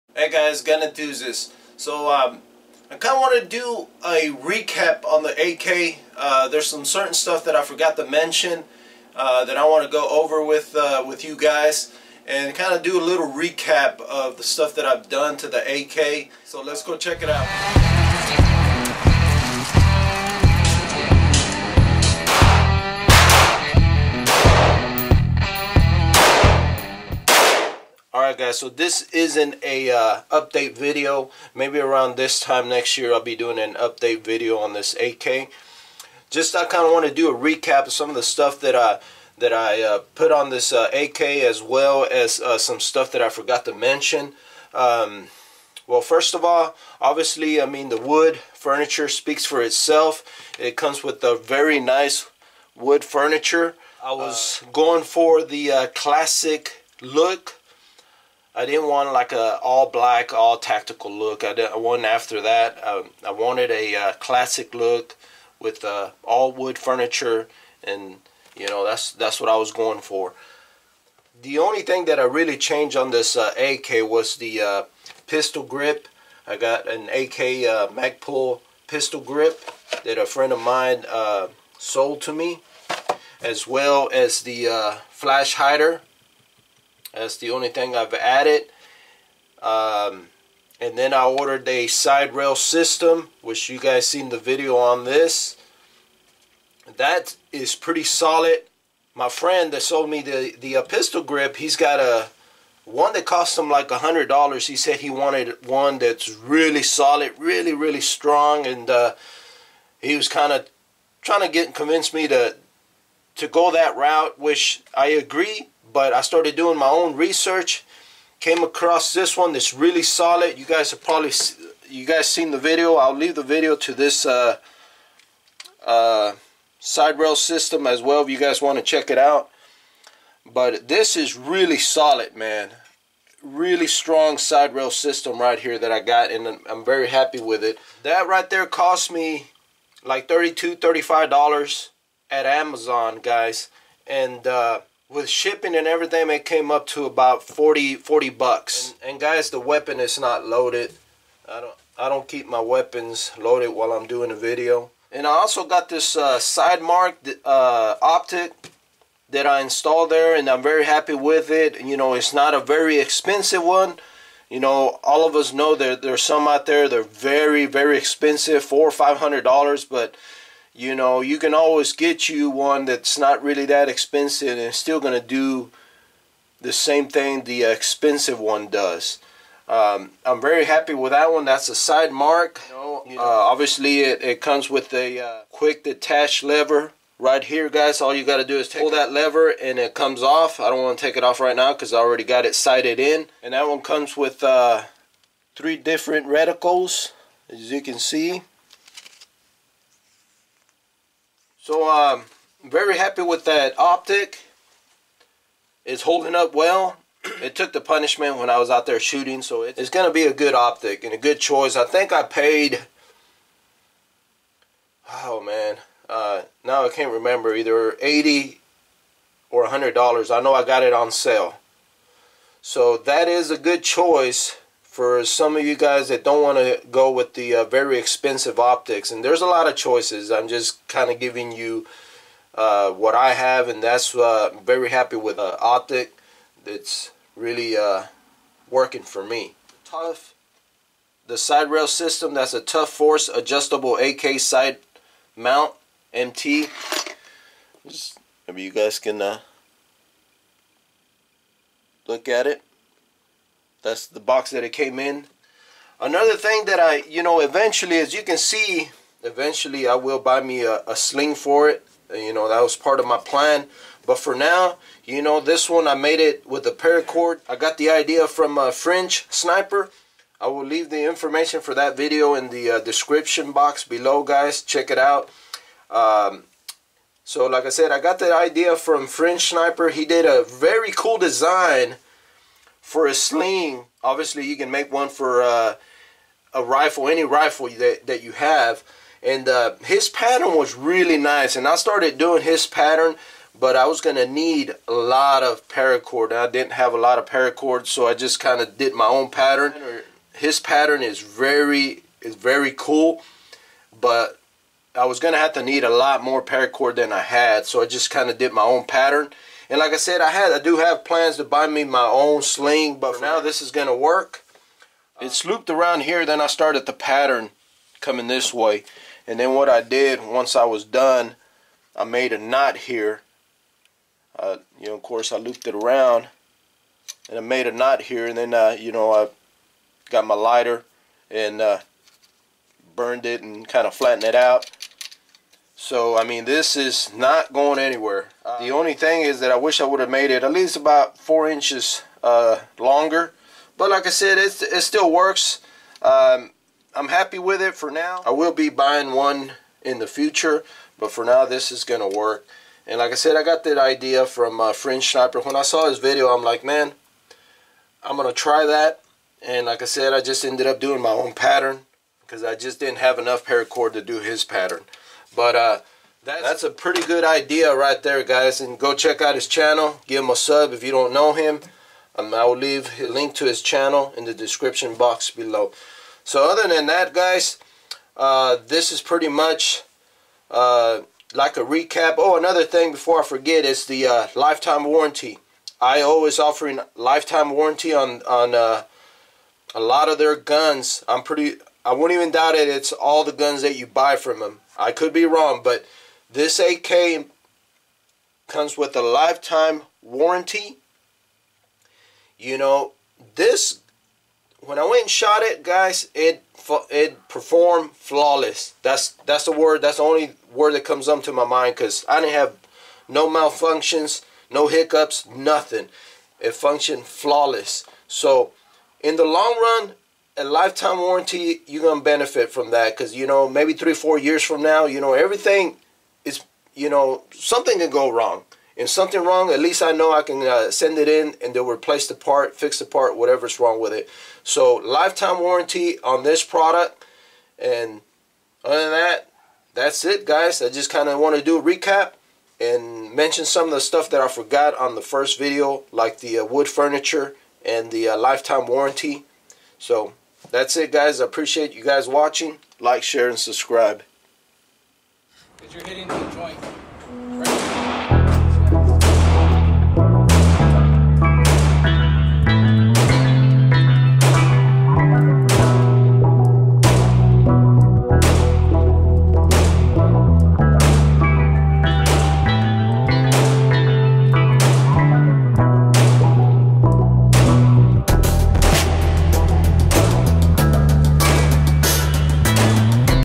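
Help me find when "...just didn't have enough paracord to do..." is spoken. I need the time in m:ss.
6:02.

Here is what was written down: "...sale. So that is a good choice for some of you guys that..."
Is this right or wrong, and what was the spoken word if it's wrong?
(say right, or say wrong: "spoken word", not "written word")
right.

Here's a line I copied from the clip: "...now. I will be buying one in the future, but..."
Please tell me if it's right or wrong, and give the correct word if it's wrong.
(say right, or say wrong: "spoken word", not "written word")
right.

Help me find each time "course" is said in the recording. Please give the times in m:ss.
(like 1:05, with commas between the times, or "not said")
5:25.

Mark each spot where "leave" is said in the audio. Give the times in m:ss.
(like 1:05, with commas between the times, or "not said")
2:03, 4:30, 6:12.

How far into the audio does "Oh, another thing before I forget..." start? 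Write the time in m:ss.
6:22.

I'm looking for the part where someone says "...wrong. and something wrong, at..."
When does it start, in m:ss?
7:08.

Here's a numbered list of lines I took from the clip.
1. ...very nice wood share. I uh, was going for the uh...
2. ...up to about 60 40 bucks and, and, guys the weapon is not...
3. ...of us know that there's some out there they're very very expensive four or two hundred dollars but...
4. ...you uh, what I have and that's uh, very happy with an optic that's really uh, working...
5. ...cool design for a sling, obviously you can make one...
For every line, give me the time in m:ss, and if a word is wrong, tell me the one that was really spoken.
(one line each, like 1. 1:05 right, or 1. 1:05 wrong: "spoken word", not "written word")
1. 0:51 wrong: "furniture", not "share"
2. 2:26 wrong: "40", not "60"
3. 2:45 wrong: "five", not "two"
4. 3:51 right
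5. 4:40 right.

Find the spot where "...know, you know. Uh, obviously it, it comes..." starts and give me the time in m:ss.
3:02.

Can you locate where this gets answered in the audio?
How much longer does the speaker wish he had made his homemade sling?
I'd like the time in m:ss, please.
5:41.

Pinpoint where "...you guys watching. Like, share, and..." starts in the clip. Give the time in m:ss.
7:31.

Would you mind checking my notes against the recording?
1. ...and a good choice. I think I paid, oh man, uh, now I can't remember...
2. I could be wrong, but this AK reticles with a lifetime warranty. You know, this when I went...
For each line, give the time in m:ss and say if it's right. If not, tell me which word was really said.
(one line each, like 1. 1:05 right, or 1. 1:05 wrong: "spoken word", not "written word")
1. 3:31 right
2. 6:34 wrong: "comes", not "reticles".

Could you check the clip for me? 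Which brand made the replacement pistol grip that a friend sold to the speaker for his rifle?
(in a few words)
Magpul.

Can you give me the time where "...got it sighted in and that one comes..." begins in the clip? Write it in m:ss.
3:12.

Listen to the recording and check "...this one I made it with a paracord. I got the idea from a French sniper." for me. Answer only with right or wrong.
right.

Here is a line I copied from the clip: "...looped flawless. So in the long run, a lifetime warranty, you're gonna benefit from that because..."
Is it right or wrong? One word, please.
wrong.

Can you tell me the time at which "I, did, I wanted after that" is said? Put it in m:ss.
1:01.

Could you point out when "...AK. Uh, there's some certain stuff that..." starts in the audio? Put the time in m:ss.
0:05.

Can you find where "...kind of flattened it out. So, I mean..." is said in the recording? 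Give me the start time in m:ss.
5:33.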